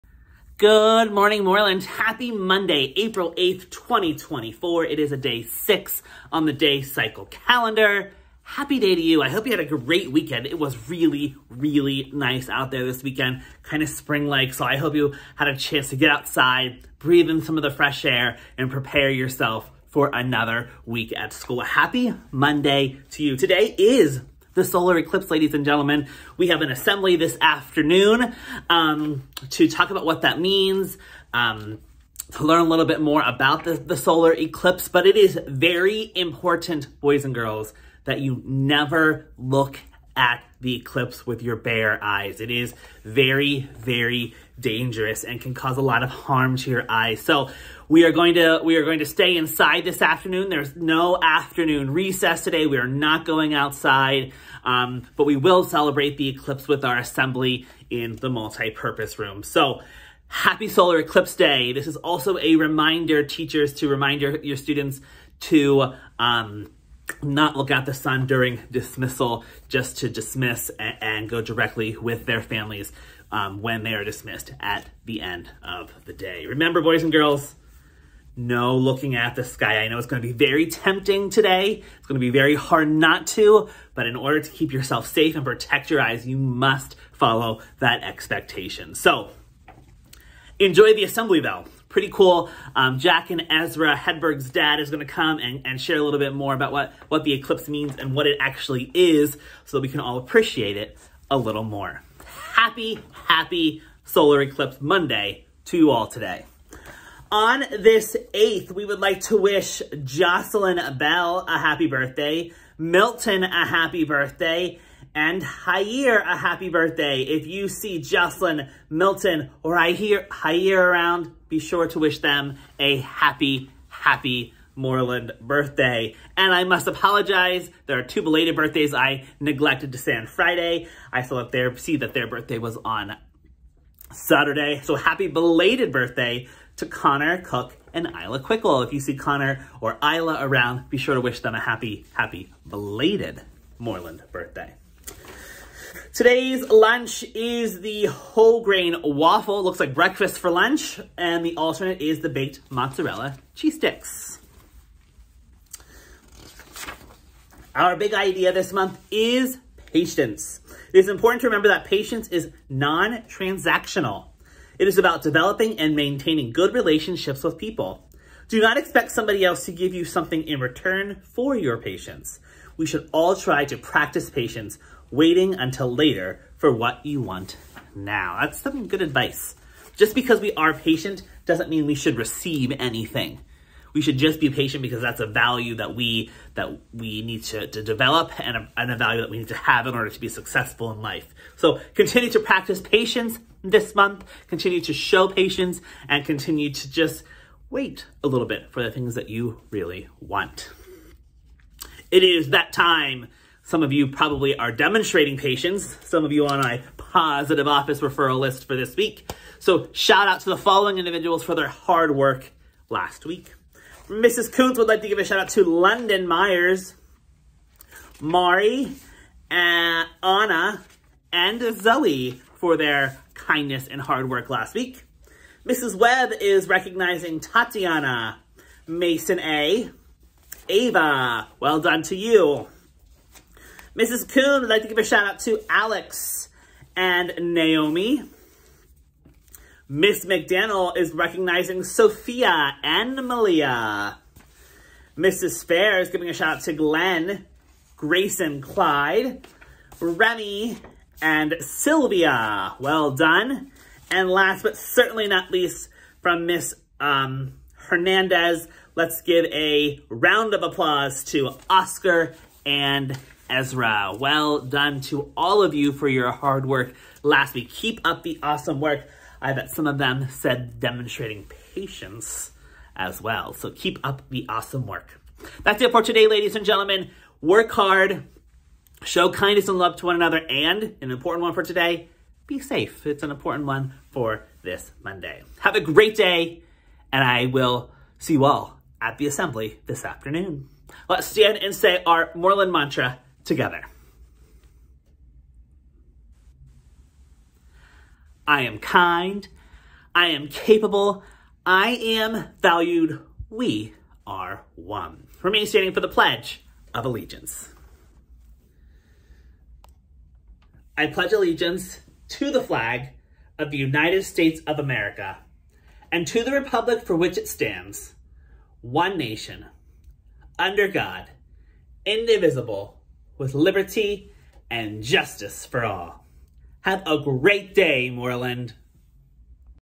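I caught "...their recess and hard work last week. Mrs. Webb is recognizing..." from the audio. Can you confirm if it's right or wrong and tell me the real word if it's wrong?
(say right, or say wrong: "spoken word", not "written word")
wrong: "kindness", not "recess".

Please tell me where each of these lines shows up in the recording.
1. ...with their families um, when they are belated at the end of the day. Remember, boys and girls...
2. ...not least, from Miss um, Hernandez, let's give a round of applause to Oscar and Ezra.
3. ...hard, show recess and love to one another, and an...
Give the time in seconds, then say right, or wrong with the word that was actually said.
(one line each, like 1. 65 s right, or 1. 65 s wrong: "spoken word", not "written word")
1. 71 s wrong: "dismissed", not "belated"
2. 255 s right
3. 277 s wrong: "kindness", not "recess".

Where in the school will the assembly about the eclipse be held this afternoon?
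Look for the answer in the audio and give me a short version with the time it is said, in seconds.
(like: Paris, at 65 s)
Multi-purpose room, at 58 s.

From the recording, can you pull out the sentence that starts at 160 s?
It is important to remember that patience is non-transactional.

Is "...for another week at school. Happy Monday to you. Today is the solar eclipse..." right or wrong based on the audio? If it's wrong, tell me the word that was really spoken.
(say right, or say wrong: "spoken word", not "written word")
right.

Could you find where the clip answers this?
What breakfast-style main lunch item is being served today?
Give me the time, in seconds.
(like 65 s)
148 s.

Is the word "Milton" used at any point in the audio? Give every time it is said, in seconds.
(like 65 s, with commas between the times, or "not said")
112 s, 118 s.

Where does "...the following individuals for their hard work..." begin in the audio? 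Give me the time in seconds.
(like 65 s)
210 s.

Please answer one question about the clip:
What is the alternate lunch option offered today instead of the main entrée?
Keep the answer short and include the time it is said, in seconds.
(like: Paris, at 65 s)
Baked mozzarella cheese sticks, at 152 s.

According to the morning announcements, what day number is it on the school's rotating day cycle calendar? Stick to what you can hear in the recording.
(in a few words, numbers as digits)
6.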